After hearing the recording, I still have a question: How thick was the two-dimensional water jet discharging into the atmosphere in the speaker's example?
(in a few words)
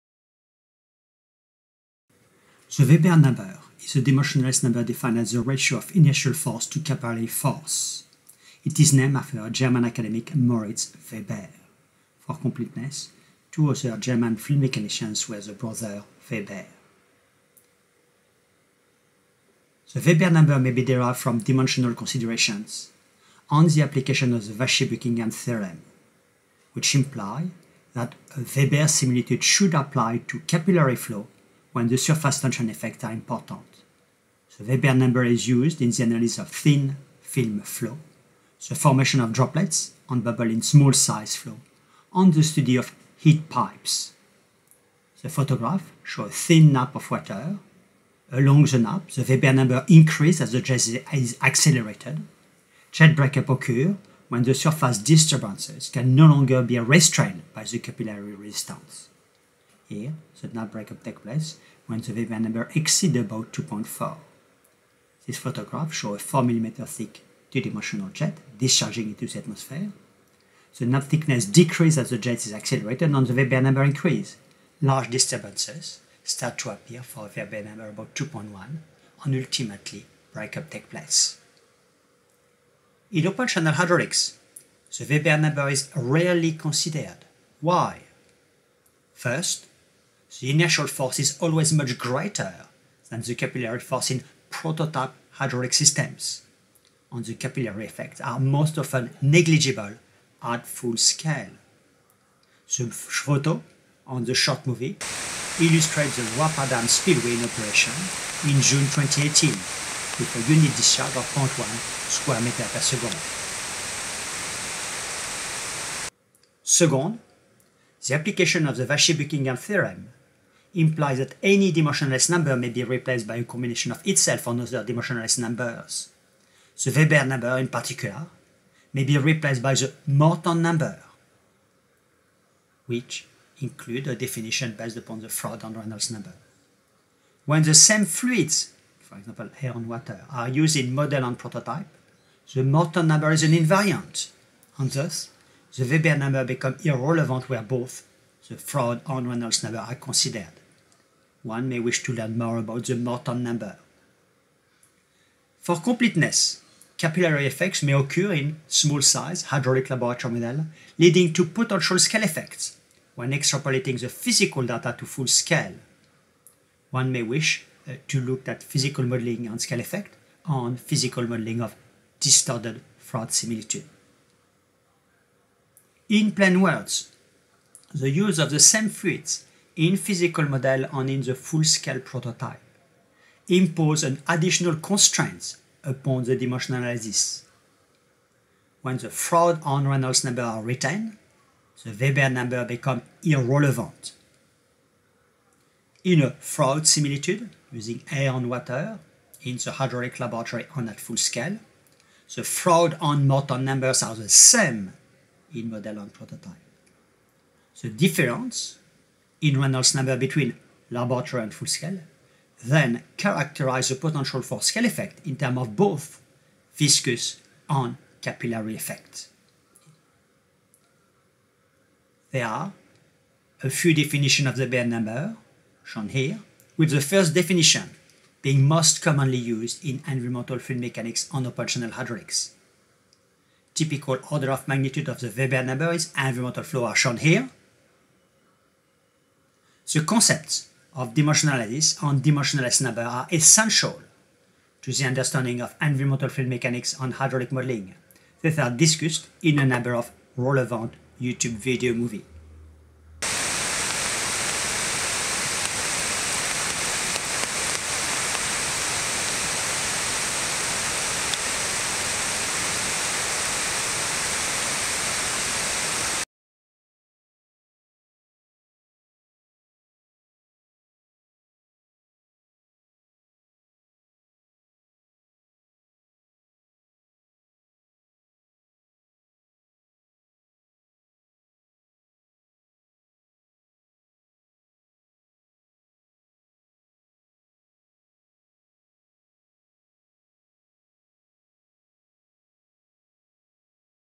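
4 mm.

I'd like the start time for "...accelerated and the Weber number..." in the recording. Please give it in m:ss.
1:12.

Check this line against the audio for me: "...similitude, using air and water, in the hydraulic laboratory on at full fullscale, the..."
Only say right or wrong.
wrong.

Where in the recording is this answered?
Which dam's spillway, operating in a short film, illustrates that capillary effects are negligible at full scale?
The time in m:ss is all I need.
1:46.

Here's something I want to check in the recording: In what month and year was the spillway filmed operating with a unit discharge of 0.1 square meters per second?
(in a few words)
June 2018.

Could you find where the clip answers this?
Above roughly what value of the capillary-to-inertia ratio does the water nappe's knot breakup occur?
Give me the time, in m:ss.
1:03.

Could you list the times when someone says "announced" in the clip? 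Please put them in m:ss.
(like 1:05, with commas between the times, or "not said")
not said.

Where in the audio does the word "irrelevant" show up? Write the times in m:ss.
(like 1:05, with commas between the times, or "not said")
2:26, 3:13.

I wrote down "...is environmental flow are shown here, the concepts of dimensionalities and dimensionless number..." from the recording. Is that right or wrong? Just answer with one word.
right.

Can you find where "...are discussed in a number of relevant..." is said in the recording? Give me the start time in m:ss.
4:08.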